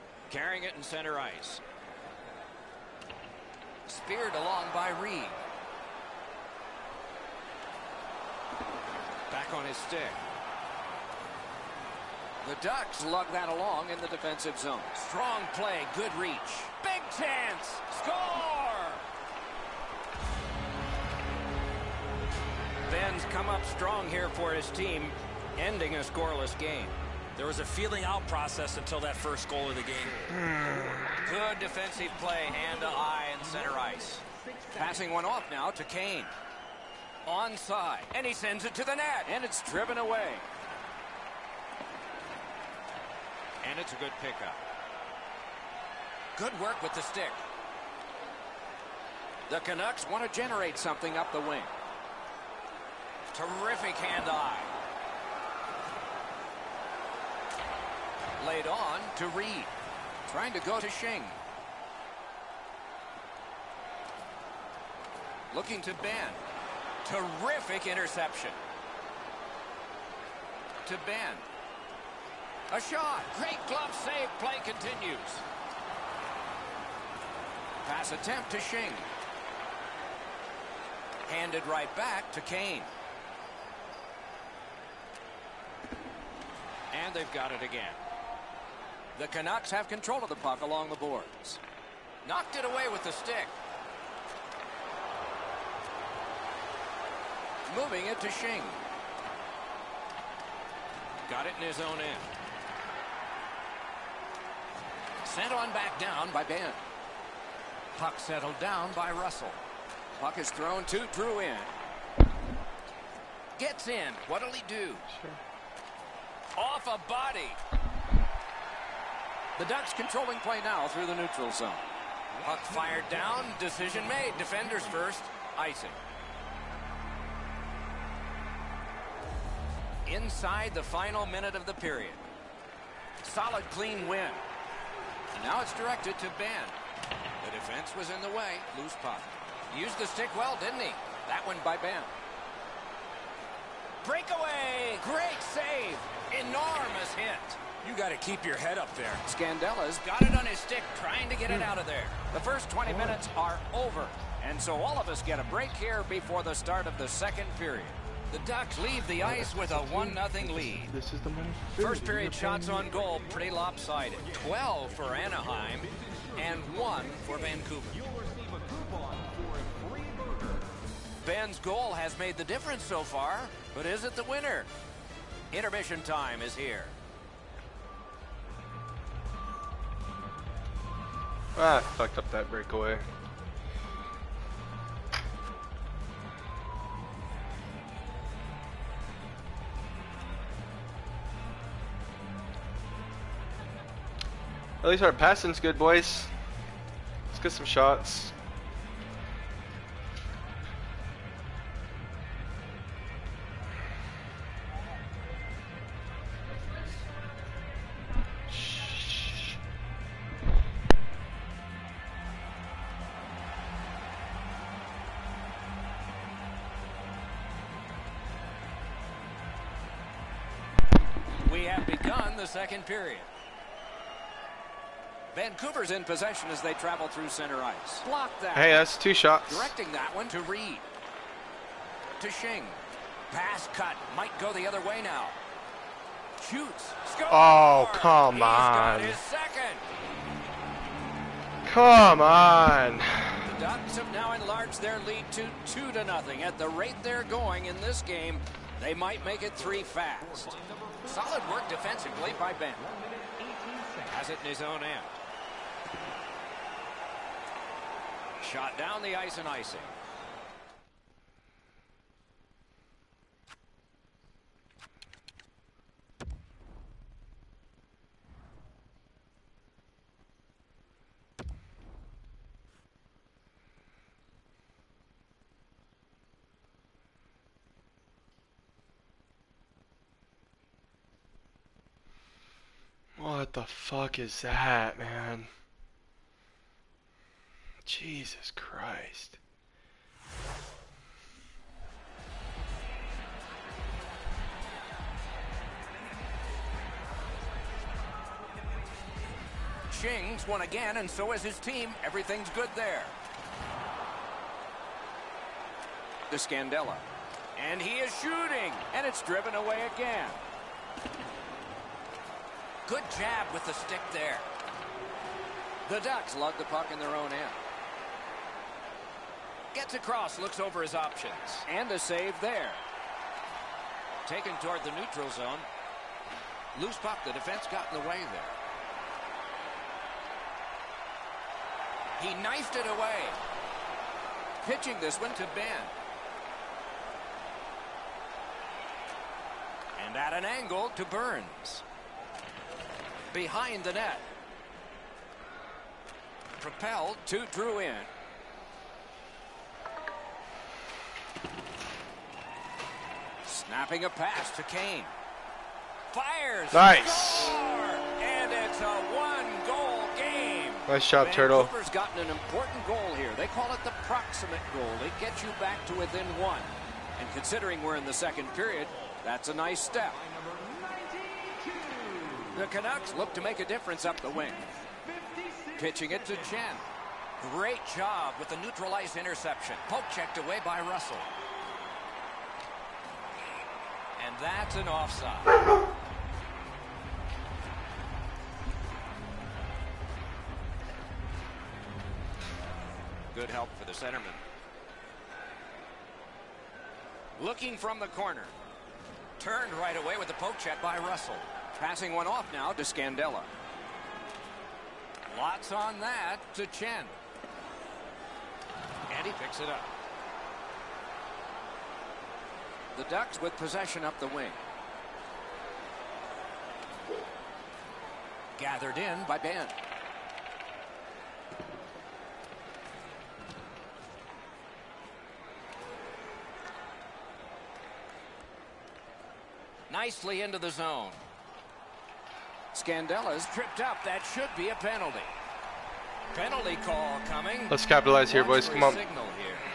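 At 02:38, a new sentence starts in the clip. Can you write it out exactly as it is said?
The Ducks leave the ice with a 1-0 lead.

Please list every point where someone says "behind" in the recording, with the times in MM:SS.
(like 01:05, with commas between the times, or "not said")
05:43.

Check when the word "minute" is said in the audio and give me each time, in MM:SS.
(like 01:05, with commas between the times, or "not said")
02:11, 02:32.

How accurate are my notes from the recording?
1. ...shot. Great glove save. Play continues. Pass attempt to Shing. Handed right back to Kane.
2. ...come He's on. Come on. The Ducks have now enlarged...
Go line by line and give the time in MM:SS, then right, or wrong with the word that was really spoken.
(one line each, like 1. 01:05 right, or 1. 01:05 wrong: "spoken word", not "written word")
1. 01:12 right
2. 03:57 right.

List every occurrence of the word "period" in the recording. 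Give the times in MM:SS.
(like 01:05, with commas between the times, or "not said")
02:11, 02:37, 02:42, 03:42, 06:08.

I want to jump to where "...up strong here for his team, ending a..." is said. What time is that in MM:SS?
00:23.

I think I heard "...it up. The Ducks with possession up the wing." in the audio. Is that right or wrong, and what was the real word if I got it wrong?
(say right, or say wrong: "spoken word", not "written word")
right.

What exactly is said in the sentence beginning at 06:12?
The Canucks look to make a difference up the wing.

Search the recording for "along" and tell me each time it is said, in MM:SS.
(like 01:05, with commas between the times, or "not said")
00:04, 00:13, 01:30.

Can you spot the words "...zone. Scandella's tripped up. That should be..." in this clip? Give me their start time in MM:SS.
07:10.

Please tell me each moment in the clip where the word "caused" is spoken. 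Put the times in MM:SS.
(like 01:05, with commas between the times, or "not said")
not said.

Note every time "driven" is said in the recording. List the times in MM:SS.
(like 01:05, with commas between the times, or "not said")
00:39, 05:09.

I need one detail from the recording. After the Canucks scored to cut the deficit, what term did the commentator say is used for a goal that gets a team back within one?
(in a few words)
The proximate goal.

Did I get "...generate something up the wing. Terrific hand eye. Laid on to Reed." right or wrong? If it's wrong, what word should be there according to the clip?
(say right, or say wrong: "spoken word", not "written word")
right.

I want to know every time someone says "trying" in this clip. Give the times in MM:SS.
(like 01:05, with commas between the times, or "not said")
01:00, 02:30.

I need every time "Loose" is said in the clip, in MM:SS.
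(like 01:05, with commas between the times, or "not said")
02:18, 05:26.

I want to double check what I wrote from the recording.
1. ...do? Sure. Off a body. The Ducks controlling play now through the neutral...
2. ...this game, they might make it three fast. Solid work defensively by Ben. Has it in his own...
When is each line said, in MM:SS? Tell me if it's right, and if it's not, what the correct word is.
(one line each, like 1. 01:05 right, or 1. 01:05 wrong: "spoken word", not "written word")
1. 01:54 right
2. 04:07 right.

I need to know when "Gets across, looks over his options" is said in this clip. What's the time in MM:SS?
05:19.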